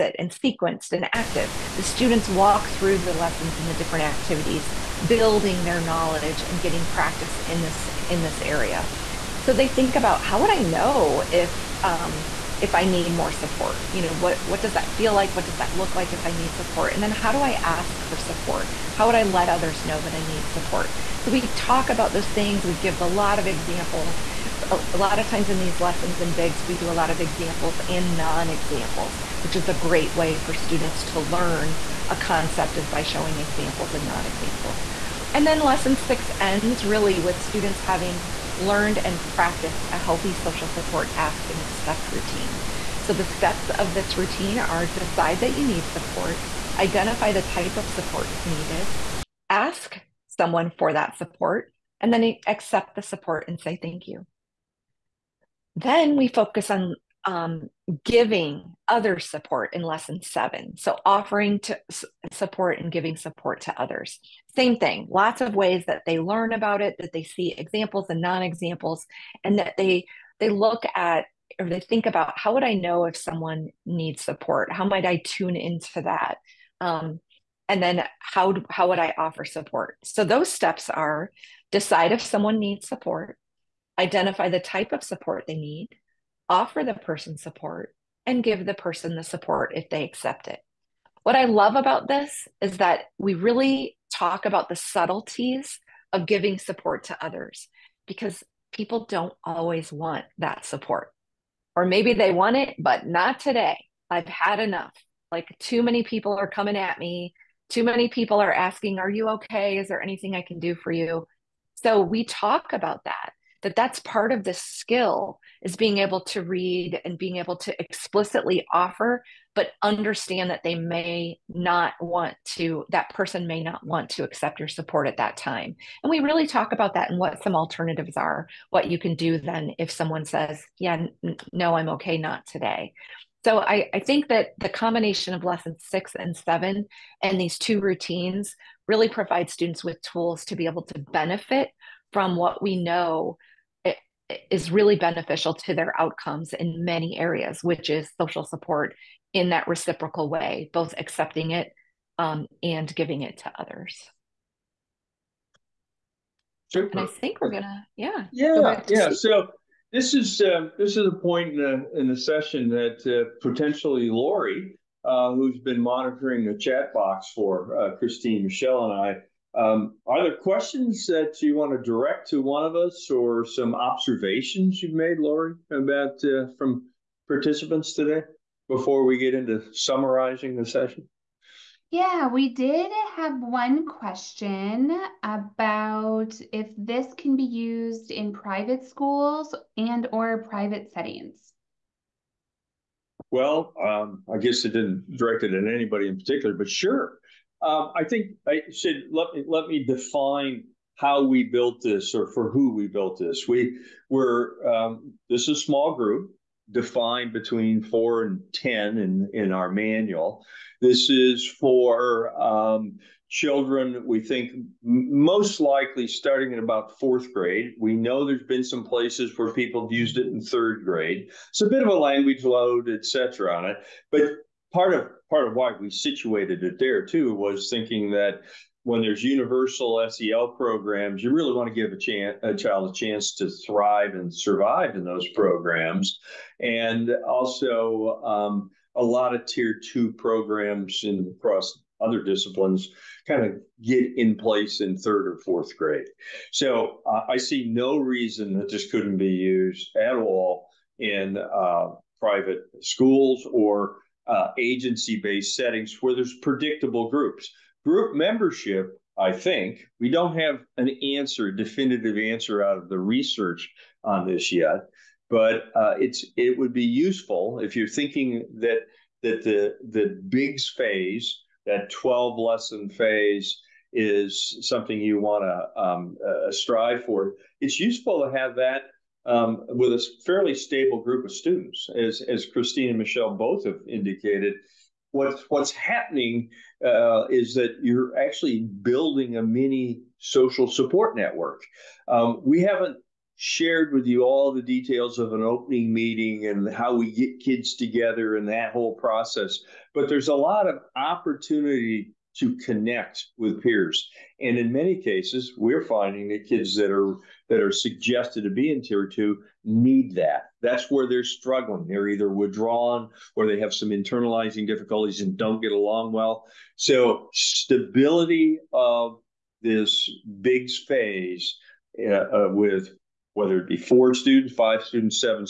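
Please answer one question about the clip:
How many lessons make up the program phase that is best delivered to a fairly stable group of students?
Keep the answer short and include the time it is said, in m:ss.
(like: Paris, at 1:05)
12, at 4:31.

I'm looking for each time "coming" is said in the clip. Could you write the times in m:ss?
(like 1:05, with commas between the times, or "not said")
1:46.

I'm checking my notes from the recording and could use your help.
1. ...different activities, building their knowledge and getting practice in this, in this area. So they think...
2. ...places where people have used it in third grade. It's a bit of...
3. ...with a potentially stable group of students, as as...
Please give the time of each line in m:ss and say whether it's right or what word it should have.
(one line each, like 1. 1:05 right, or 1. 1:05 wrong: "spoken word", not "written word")
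1. 0:03 right
2. 3:38 right
3. 4:39 wrong: "fairly", not "potentially".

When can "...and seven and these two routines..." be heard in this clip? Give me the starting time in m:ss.
2:16.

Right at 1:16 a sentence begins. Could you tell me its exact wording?
Um, and then how how would I offer support?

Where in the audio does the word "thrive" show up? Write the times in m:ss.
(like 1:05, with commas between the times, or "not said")
3:53.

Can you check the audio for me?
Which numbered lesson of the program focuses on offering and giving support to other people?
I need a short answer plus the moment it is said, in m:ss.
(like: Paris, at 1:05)
Lesson seven, at 0:59.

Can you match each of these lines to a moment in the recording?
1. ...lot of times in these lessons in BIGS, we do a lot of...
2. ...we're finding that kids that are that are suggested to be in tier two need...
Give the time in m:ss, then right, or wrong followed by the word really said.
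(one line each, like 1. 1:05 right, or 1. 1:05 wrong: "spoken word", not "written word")
1. 0:24 right
2. 5:05 right.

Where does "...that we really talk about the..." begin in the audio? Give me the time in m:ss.
1:32.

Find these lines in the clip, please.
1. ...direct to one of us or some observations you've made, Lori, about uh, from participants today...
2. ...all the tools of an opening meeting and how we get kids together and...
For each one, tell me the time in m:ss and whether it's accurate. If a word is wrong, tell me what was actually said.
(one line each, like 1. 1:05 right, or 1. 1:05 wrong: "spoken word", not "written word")
1. 2:51 right
2. 4:54 wrong: "details", not "tools".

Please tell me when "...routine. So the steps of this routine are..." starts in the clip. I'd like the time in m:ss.
0:42.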